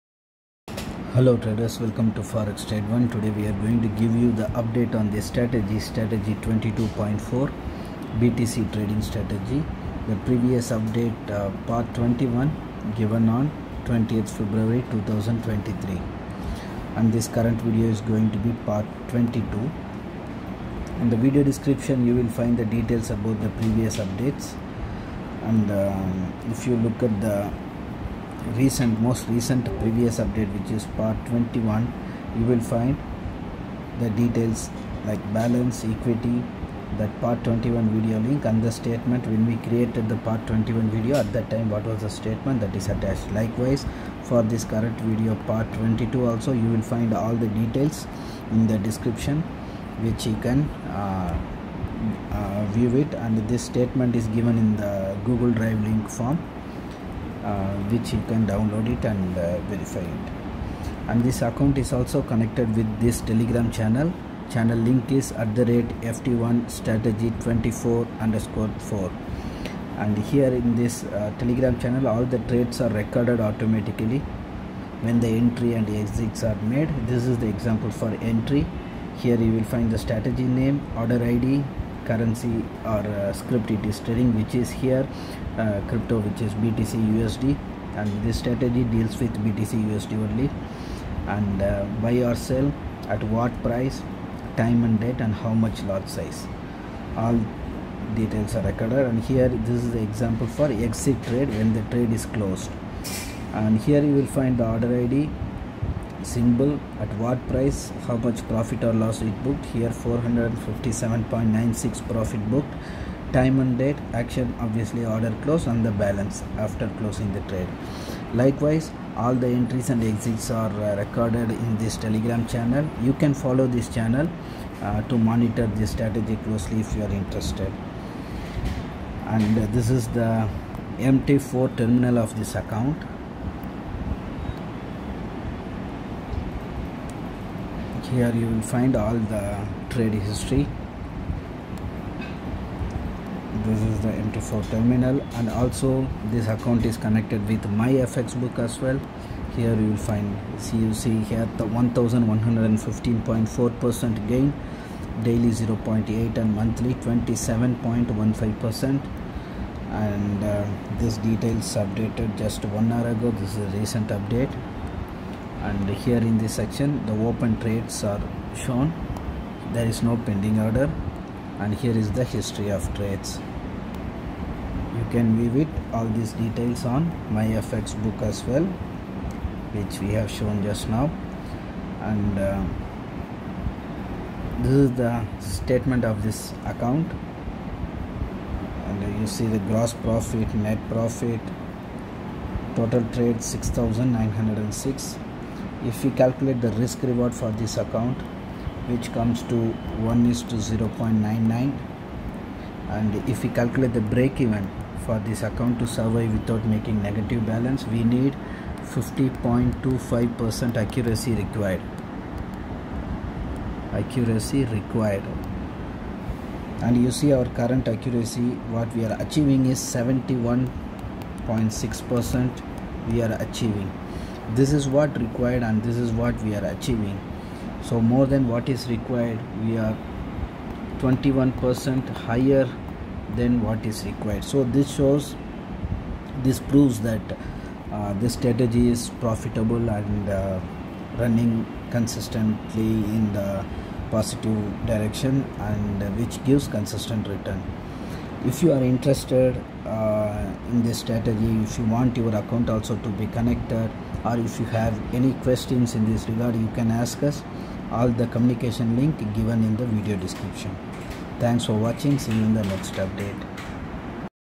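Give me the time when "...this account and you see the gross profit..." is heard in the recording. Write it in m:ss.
3:06.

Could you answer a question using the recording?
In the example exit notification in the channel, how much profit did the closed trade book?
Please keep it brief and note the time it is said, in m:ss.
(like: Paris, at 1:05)
457.96, at 1:49.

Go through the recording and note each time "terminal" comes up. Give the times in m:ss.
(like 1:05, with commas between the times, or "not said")
2:11, 2:24.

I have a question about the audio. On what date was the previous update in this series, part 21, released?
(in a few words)
20 February 2023.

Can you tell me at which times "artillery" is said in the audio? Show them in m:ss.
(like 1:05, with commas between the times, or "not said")
not said.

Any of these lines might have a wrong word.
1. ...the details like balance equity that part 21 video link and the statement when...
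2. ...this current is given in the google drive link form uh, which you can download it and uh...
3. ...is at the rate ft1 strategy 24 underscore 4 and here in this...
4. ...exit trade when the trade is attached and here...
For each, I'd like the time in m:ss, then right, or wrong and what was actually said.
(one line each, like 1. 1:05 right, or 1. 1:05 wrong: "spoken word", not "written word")
1. 0:33 right
2. 0:53 wrong: "statement", not "current"
3. 1:05 right
4. 1:40 wrong: "closed", not "attached".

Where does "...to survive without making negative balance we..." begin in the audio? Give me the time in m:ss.
3:25.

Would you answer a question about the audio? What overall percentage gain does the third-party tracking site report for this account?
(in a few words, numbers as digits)
1115.4%.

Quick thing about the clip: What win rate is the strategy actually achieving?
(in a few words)
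71.6%.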